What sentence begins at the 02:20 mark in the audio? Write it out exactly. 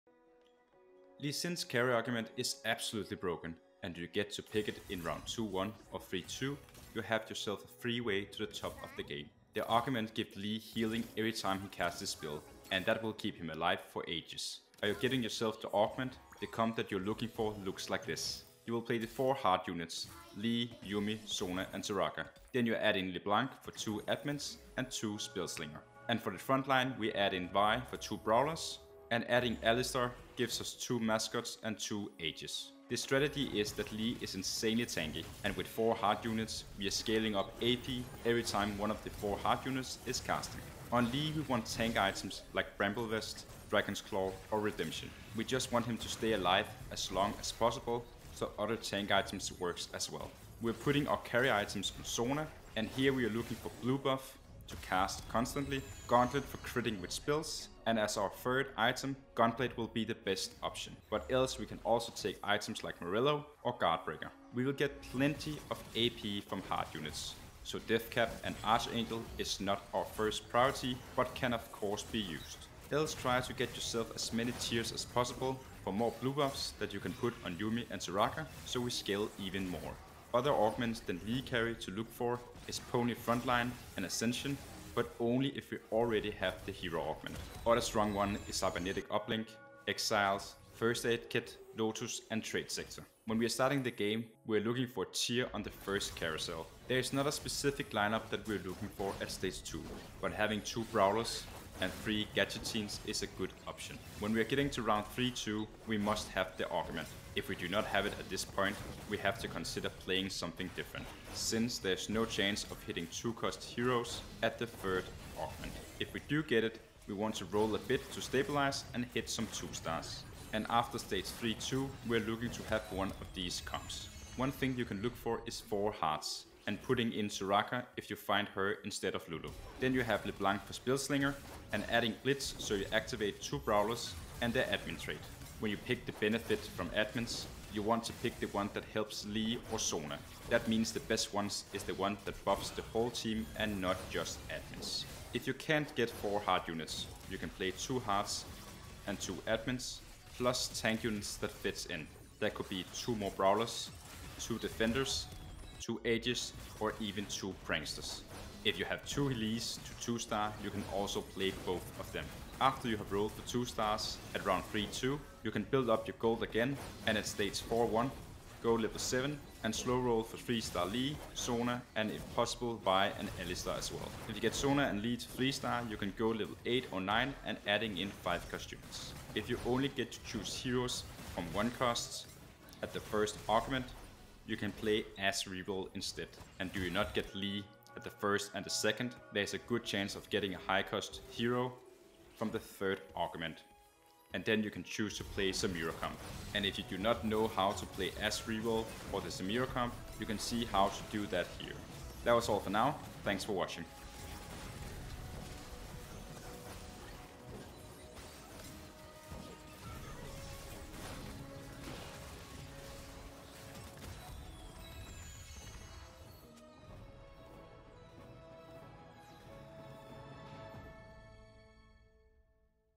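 That means the best ones is the one that buffs the whole team and not just admins.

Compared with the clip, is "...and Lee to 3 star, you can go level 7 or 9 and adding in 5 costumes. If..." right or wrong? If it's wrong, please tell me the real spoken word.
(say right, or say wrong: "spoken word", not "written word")
wrong: "8", not "7".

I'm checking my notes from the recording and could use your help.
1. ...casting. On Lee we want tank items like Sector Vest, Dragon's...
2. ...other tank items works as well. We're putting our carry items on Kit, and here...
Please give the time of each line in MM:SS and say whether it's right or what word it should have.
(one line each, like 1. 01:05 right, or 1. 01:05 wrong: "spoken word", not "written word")
1. 00:40 wrong: "Bramble", not "Sector"
2. 00:48 wrong: "Sona", not "Kit".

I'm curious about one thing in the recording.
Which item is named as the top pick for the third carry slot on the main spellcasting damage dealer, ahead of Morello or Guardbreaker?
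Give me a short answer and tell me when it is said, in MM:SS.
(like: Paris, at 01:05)
Gunblade, at 00:59.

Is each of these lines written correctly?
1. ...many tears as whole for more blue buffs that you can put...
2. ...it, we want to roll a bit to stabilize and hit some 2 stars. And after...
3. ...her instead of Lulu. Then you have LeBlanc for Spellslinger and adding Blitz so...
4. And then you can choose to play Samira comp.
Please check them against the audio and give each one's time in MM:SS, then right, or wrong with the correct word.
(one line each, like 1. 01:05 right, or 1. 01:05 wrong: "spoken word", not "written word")
1. 01:14 wrong: "possible", not "whole"
2. 01:56 right
3. 02:08 right
4. 03:14 right.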